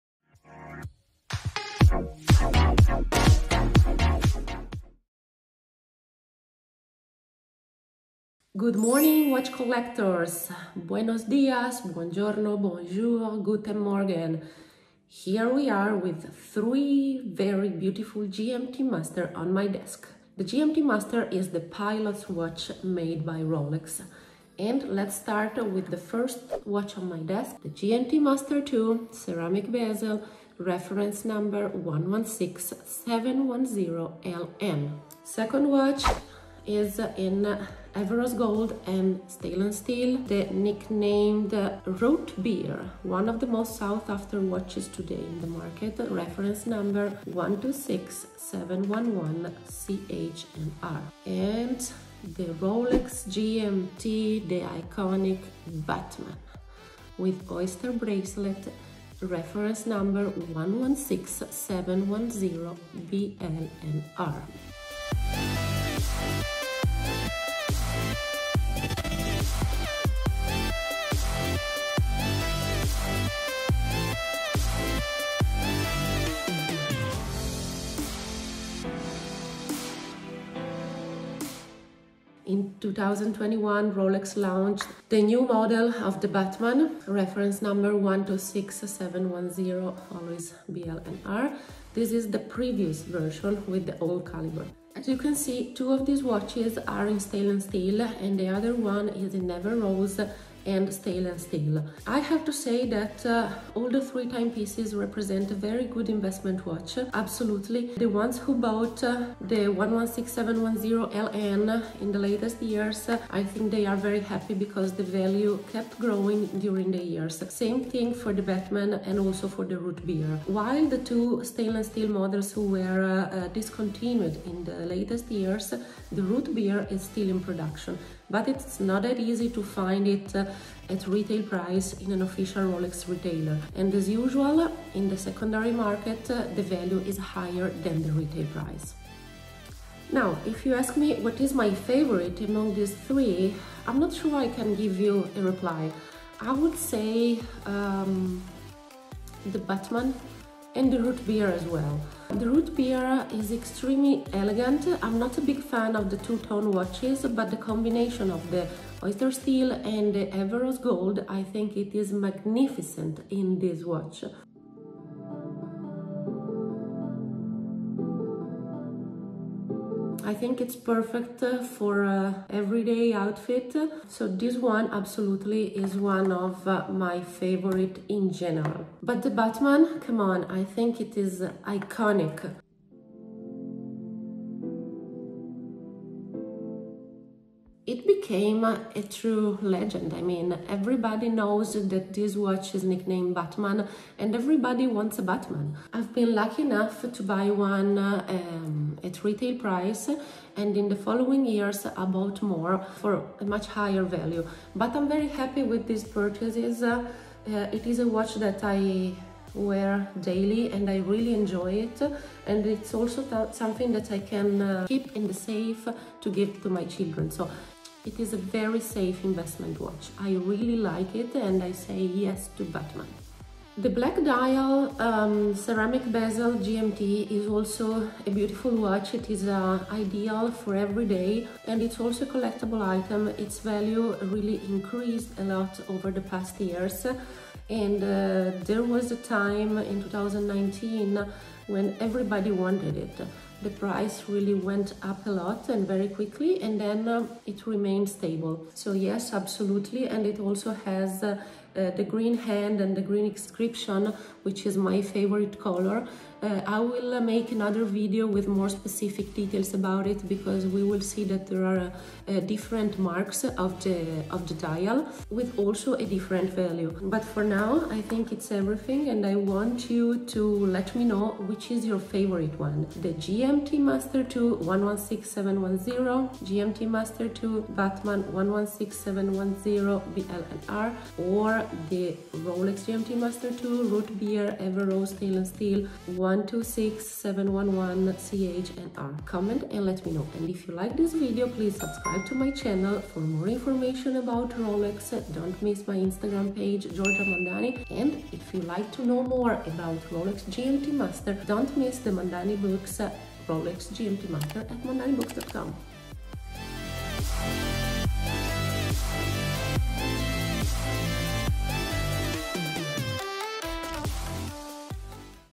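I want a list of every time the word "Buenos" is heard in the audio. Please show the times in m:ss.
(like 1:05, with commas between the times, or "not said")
0:10.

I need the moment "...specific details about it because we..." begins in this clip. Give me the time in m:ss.
4:18.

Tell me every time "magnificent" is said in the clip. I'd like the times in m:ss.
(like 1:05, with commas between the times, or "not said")
2:42.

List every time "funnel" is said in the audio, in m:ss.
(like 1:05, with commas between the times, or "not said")
not said.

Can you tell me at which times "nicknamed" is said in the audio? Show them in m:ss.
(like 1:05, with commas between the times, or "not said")
0:40, 3:12.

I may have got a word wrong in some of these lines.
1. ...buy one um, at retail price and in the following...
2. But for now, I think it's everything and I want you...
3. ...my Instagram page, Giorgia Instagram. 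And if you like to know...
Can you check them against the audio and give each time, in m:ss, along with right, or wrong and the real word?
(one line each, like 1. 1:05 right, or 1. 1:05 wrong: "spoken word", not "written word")
1. 3:17 right
2. 4:27 right
3. 4:55 wrong: "Mondani", not "Instagram".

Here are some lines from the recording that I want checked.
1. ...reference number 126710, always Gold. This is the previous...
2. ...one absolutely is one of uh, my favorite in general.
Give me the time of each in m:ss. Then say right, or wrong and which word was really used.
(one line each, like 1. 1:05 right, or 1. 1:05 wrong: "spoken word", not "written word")
1. 1:27 wrong: "BLNR", not "Gold"
2. 2:54 right.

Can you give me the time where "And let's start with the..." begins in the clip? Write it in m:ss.
0:24.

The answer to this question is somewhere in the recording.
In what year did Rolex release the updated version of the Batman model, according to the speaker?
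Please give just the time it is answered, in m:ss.
1:22.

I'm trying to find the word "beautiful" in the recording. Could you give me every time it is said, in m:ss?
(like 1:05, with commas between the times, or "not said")
0:17, 3:48.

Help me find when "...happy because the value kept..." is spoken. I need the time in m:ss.
1:54.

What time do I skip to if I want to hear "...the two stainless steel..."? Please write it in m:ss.
2:00.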